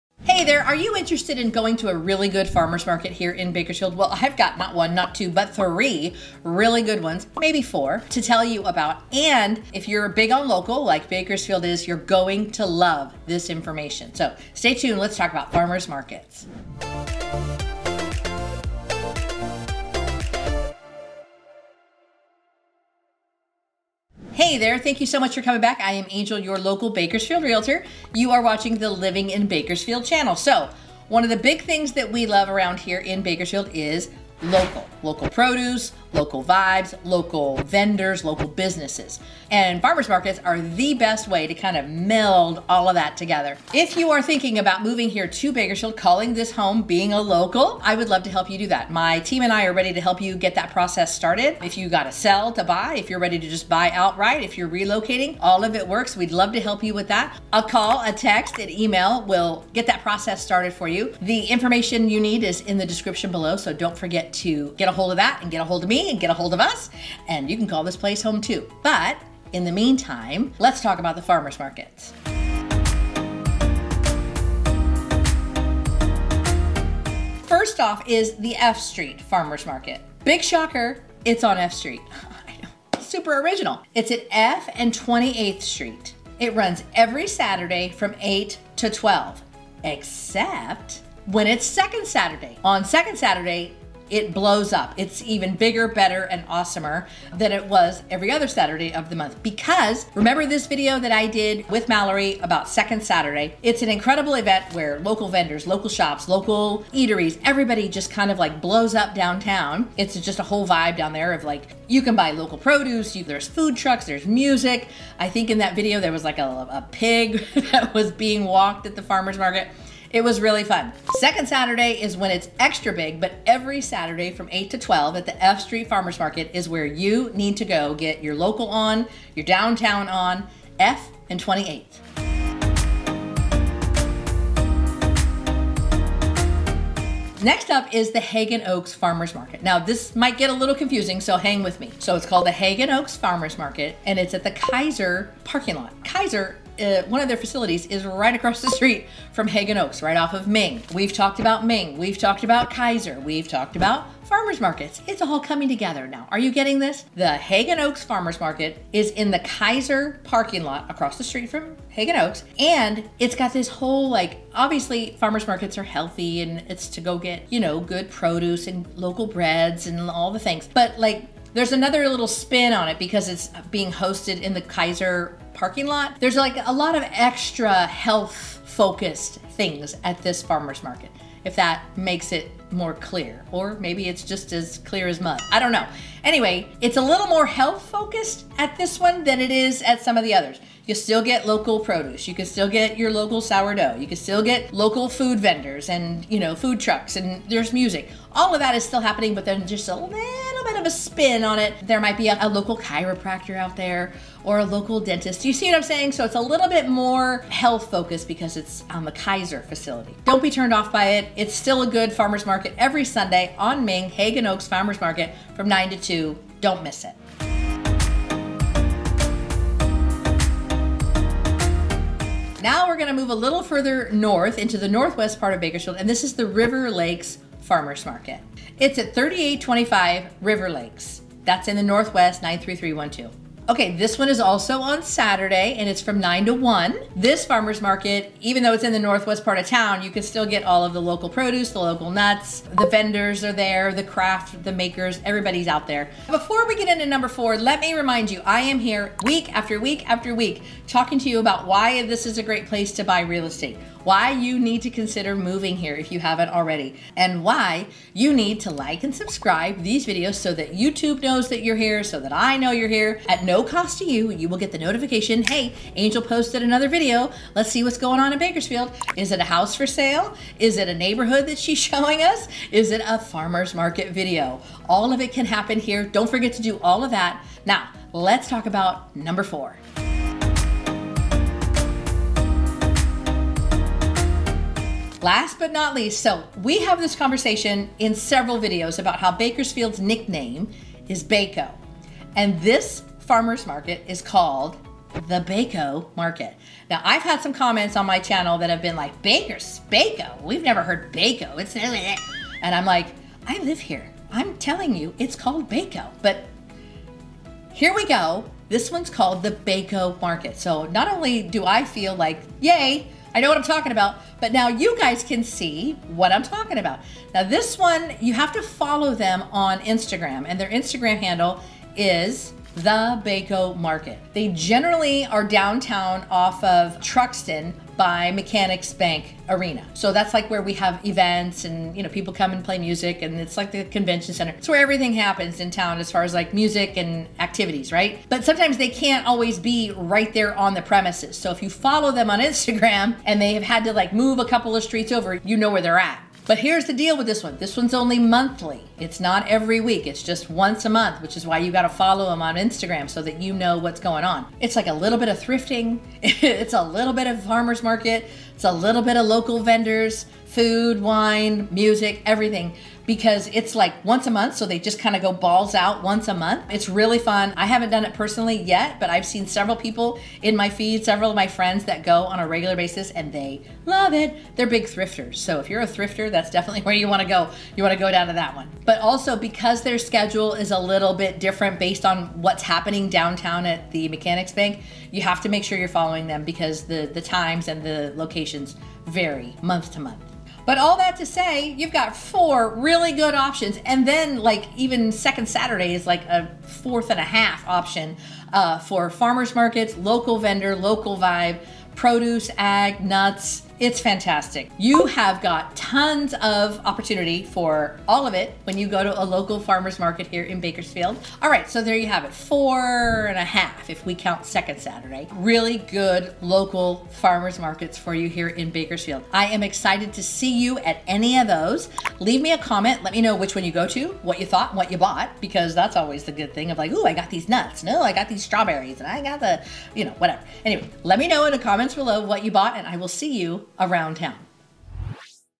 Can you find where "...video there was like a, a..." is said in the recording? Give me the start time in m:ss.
1:55.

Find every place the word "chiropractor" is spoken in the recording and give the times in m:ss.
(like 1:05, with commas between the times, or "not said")
3:22.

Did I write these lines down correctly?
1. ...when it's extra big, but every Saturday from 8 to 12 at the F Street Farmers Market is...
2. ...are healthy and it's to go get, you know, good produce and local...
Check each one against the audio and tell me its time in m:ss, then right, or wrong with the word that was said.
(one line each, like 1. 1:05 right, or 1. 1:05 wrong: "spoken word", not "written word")
1. 2:02 right
2. 2:45 right.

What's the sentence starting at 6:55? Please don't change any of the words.
Really good local farmer's markets for you here in Bakersfield.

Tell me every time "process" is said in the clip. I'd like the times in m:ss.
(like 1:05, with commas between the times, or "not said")
0:50, 1:00.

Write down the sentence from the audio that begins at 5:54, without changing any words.
It's like a little bit of thrifting.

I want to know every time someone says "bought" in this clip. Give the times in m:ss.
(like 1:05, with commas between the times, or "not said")
7:04, 7:12.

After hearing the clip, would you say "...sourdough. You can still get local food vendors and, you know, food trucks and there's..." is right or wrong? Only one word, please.
right.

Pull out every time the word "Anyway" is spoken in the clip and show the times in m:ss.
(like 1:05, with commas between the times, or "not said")
3:06, 7:10.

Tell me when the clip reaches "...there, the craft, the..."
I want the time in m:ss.
4:03.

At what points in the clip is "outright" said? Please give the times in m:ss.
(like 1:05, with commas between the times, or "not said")
0:53.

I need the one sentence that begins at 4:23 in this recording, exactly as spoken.
At no cost to you, you will get the notification, hey, Angel posted another video.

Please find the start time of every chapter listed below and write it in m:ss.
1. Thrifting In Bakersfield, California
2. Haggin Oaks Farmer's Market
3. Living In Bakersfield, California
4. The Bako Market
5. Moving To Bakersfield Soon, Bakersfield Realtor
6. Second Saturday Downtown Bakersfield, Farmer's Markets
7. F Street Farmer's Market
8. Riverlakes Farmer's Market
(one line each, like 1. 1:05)
1. 6:16
2. 2:14
3. 4:09
4. 4:42
5. 0:45
6. 1:41
7. 1:20
8. 3:40.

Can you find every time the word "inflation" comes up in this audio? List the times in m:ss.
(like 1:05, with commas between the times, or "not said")
not said.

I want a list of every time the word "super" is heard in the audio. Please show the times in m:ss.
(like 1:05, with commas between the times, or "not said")
1:22.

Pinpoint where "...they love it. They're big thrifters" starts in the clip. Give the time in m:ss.
6:13.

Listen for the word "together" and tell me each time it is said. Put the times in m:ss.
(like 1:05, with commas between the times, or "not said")
0:43, 2:35.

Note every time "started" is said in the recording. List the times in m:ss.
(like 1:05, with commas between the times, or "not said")
0:51, 1:00.